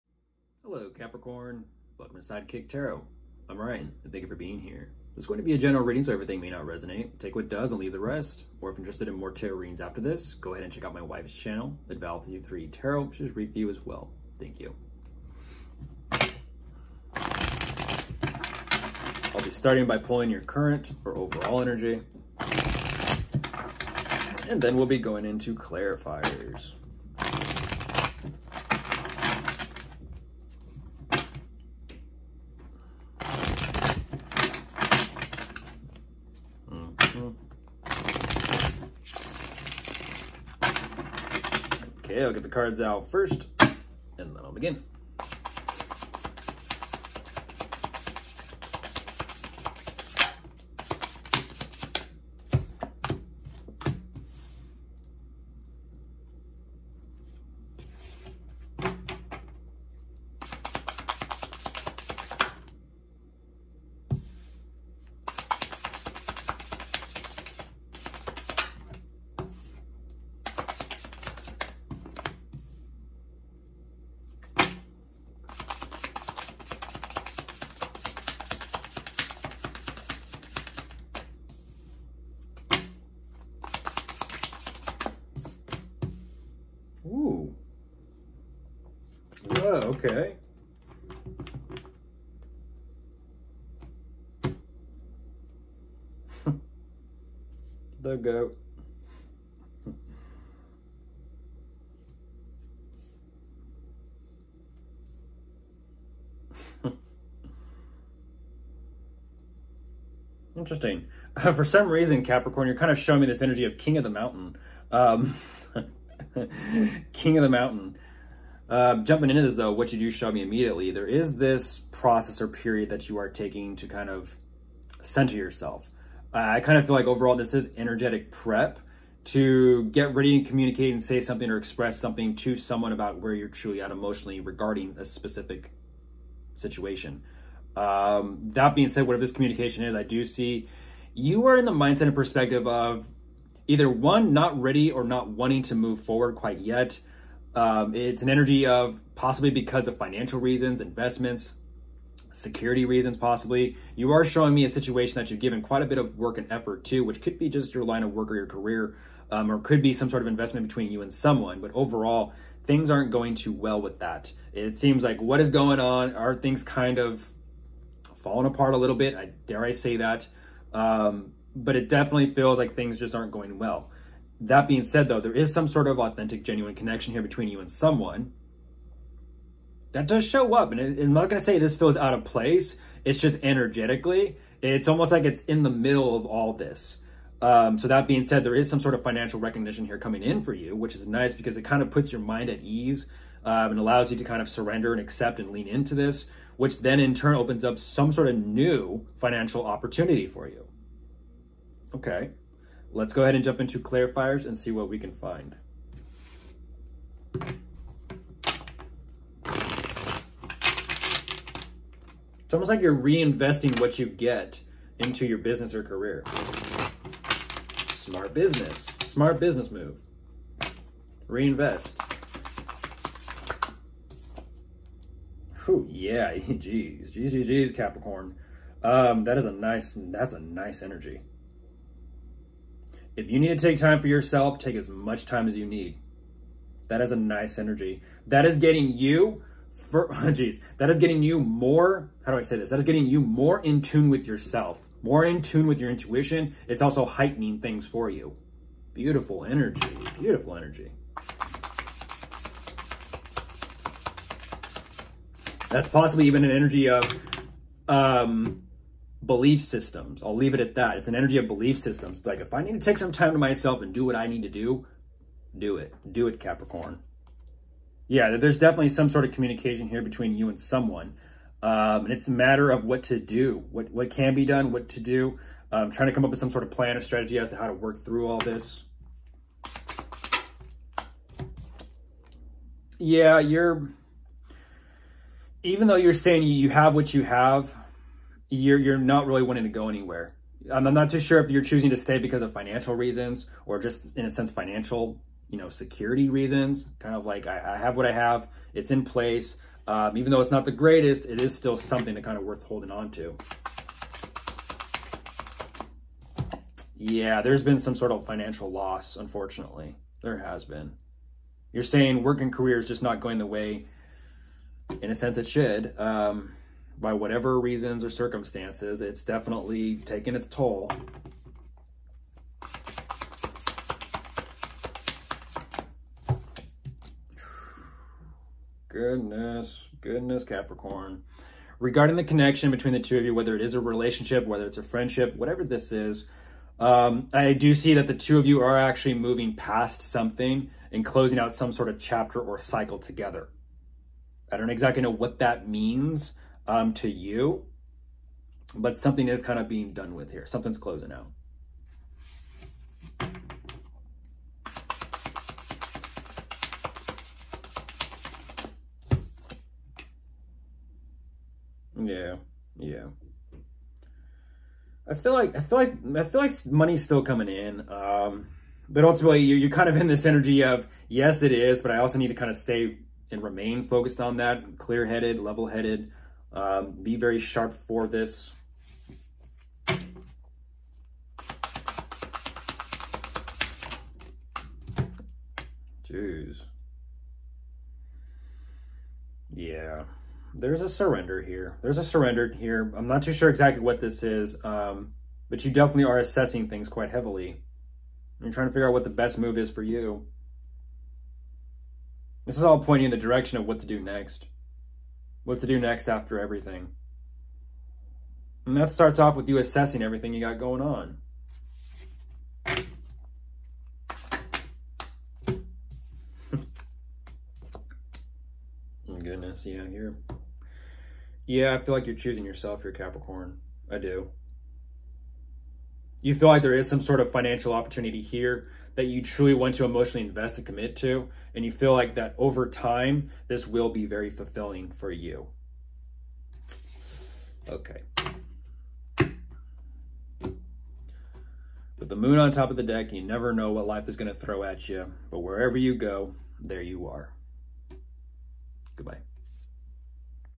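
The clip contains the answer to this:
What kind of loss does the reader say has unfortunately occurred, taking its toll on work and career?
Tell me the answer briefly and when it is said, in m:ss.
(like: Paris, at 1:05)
financial loss, at 5:08.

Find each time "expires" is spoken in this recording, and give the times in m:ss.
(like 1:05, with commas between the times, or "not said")
not said.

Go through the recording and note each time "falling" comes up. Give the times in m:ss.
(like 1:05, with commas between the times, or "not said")
2:48.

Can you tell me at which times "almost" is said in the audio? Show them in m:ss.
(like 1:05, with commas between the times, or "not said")
3:04, 3:32.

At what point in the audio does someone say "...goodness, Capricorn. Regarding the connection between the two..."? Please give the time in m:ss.
5:30.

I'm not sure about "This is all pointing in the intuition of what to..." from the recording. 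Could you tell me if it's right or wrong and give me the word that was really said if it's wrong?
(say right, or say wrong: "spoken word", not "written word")
wrong: "direction", not "intuition".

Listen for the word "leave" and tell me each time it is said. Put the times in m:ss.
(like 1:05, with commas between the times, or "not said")
0:07, 4:20.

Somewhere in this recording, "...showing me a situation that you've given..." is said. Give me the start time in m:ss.
2:34.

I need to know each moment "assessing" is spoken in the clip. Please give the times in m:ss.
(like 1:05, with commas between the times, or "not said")
6:36, 6:49.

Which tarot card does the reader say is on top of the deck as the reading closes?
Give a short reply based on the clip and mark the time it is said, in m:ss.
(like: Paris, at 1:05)
the moon, at 7:22.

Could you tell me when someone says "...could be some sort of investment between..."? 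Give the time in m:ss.
2:39.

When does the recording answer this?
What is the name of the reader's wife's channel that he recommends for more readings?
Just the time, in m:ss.
0:11.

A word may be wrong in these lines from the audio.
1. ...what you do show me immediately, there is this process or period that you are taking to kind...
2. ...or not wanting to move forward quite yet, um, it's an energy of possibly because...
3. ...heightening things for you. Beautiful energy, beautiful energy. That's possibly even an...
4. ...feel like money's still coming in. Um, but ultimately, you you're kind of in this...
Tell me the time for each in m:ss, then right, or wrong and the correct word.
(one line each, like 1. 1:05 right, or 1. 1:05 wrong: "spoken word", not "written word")
1. 1:59 right
2. 2:24 right
3. 4:07 right
4. 6:06 right.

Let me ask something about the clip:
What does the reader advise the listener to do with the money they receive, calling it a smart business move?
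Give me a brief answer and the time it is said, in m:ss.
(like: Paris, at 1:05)
Reinvest, at 3:41.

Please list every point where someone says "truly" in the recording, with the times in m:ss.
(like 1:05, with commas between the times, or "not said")
2:13, 7:09.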